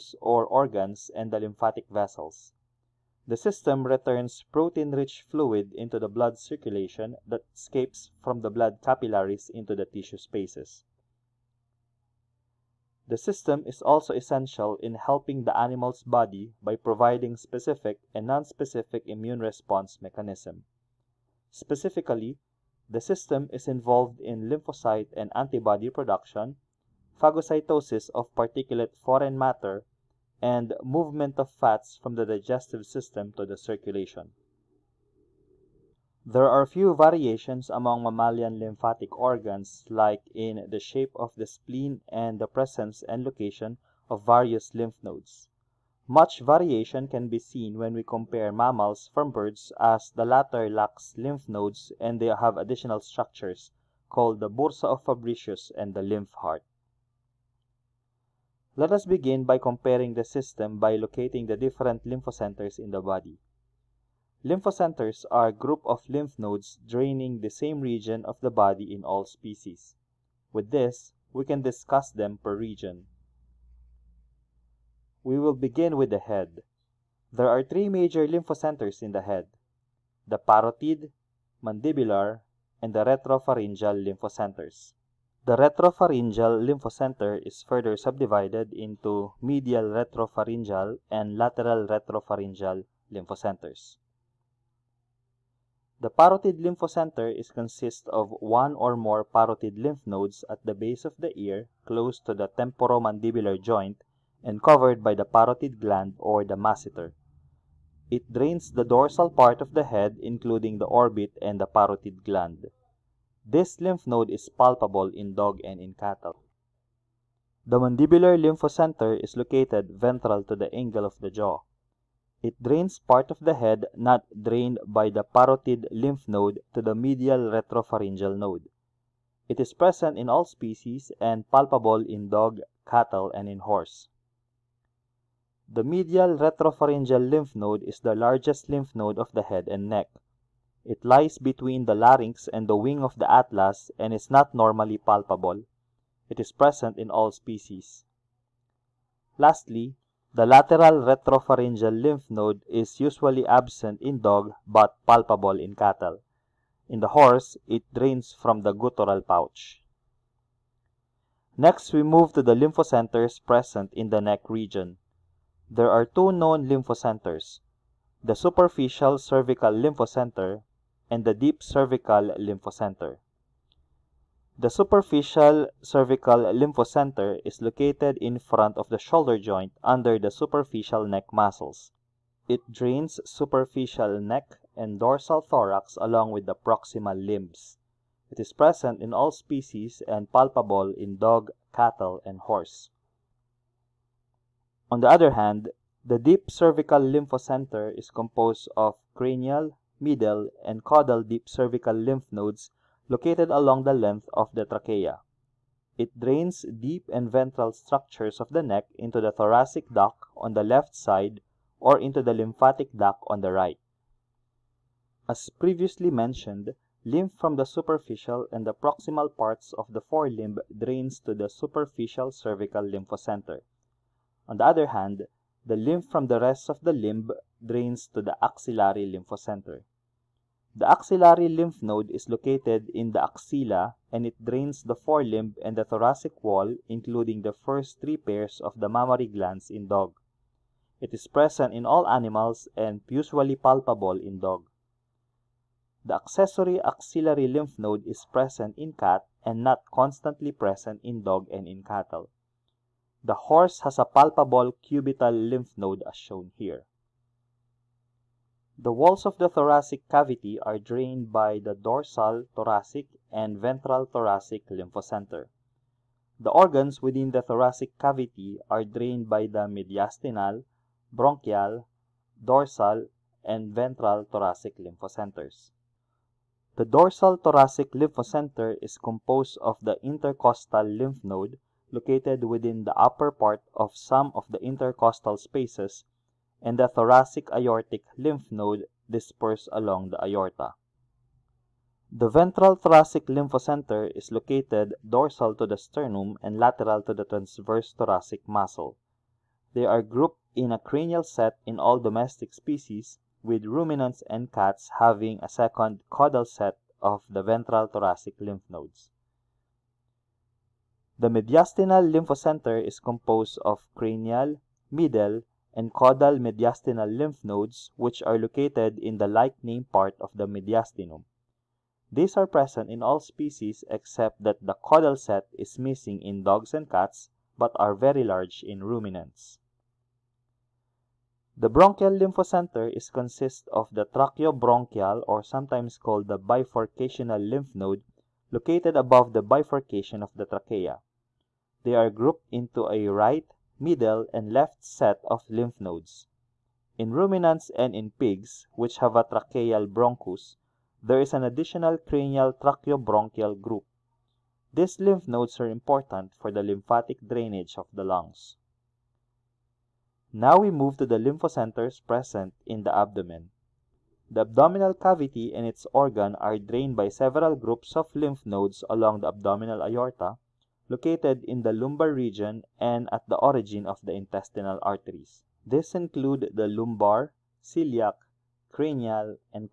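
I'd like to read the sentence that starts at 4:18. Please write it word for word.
The walls of the thoracic cavity are drained by the dorsal thoracic and ventral thoracic lymphocenter.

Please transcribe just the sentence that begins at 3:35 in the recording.
As previously mentioned, lymph from the superficial and the proximal parts of the forelimb drains to the superficial cervical lymphocenter.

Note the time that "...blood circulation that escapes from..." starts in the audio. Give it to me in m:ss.
0:06.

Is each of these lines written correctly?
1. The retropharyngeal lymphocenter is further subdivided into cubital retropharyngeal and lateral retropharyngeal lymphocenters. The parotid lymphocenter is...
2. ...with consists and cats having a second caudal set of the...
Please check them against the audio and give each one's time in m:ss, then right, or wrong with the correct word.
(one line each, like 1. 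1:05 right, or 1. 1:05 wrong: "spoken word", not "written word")
1. 1:25 wrong: "medial", not "cubital"
2. 5:03 wrong: "ruminants", not "consists".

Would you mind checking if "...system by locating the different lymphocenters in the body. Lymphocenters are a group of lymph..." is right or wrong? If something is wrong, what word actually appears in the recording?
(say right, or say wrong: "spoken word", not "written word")
right.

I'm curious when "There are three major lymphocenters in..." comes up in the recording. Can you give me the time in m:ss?
1:17.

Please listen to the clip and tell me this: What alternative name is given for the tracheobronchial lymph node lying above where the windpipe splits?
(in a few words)
Bifurcational lymph node.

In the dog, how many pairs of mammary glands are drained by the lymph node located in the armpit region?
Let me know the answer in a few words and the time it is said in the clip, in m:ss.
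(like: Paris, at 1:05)
3, at 3:57.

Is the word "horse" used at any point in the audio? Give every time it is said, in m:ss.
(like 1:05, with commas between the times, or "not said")
2:13, 2:37, 3:12, 4:13.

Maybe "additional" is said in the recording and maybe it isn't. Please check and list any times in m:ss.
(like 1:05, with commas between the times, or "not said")
0:52, 5:51.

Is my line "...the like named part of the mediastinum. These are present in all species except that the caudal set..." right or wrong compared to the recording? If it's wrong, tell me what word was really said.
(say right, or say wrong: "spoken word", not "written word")
right.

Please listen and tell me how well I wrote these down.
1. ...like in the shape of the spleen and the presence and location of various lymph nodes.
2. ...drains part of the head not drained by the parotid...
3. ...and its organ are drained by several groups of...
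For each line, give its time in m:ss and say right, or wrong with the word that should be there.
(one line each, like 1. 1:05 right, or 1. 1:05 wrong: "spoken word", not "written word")
1. 0:39 right
2. 2:02 right
3. 6:05 right.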